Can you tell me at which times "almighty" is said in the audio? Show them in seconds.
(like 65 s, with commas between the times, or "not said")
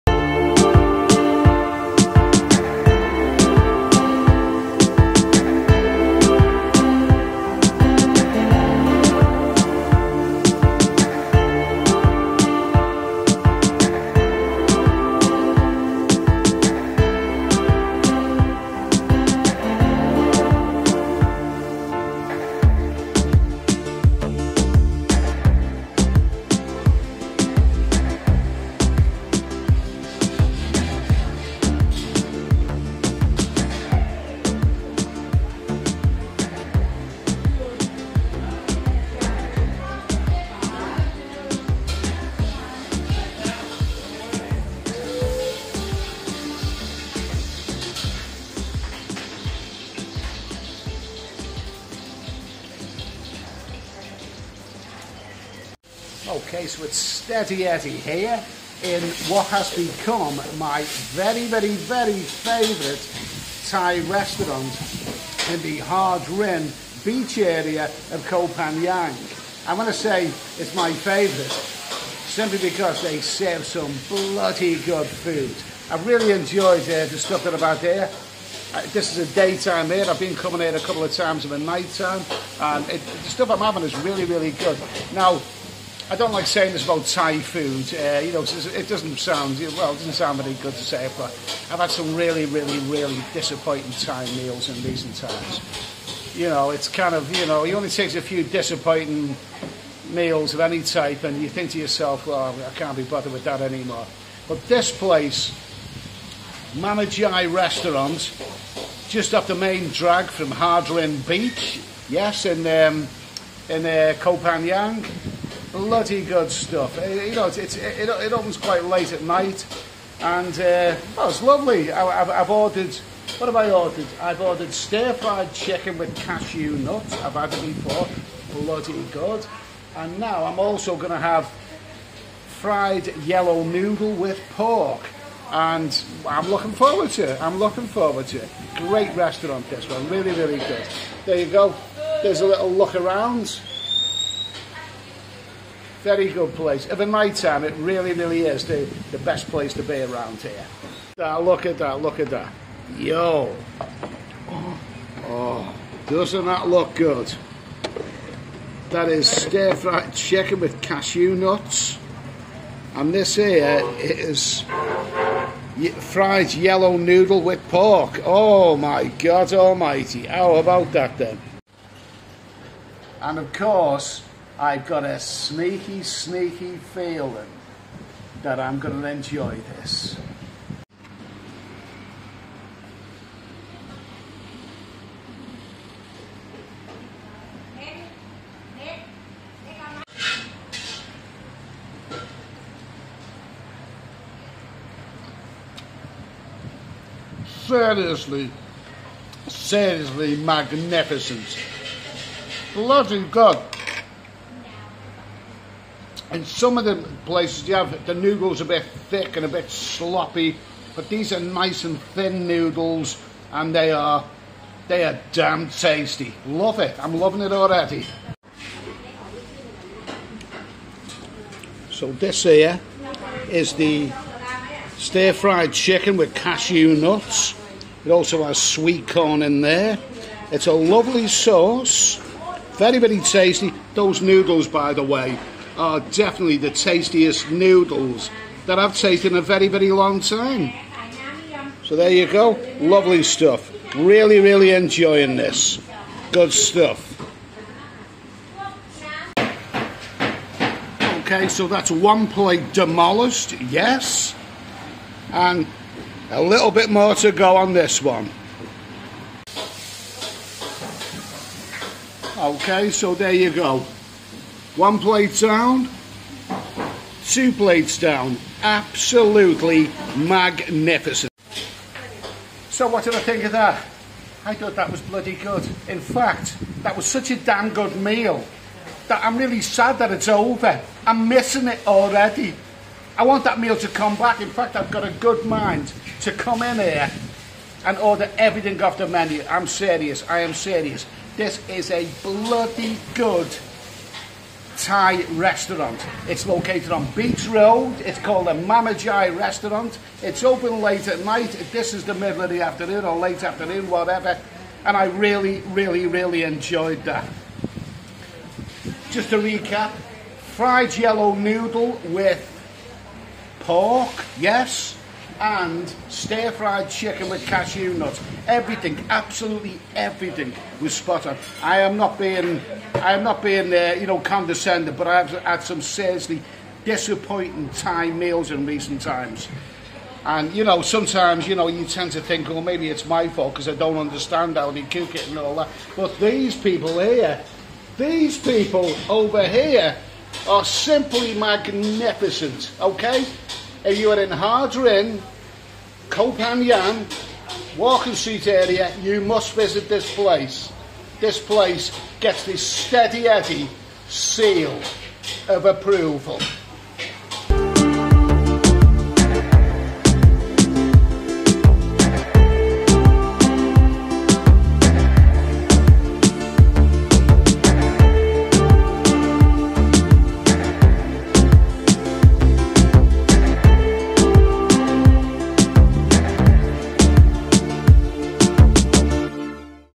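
169 s.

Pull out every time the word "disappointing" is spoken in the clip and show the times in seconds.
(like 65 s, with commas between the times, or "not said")
93 s, 98 s, 326 s.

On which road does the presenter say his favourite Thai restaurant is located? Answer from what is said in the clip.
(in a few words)
Beach Road.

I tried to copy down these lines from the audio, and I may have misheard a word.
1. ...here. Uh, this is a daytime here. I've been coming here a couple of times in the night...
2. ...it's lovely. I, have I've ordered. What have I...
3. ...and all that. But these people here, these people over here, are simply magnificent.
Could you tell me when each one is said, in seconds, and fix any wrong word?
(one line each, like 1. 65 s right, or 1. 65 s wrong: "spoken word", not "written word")
1. 77 s right
2. 121 s right
3. 335 s right.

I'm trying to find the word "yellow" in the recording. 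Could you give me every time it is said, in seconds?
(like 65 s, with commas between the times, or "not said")
133 s, 166 s, 310 s.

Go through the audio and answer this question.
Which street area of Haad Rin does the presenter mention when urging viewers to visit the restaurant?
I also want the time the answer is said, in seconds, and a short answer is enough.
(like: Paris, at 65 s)
Walking Street, at 347 s.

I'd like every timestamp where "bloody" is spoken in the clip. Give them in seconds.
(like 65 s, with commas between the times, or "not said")
74 s, 115 s, 128 s, 202 s, 275 s, 292 s.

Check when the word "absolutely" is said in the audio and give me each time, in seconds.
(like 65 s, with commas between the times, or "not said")
268 s, 319 s.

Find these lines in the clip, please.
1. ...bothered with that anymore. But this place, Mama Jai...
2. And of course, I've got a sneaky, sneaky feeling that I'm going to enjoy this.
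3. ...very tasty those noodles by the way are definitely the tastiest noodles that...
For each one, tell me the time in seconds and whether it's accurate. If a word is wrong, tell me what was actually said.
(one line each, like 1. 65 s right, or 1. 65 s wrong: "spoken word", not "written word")
1. 103 s right
2. 173 s right
3. 232 s right.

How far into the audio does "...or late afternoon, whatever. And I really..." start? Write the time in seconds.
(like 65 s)
303 s.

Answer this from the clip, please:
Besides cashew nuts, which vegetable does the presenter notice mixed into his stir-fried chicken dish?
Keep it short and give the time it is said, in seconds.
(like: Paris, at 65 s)
Sweet corn, at 228 s.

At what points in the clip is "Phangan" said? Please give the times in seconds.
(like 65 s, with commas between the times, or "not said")
68 s, 114 s, 346 s.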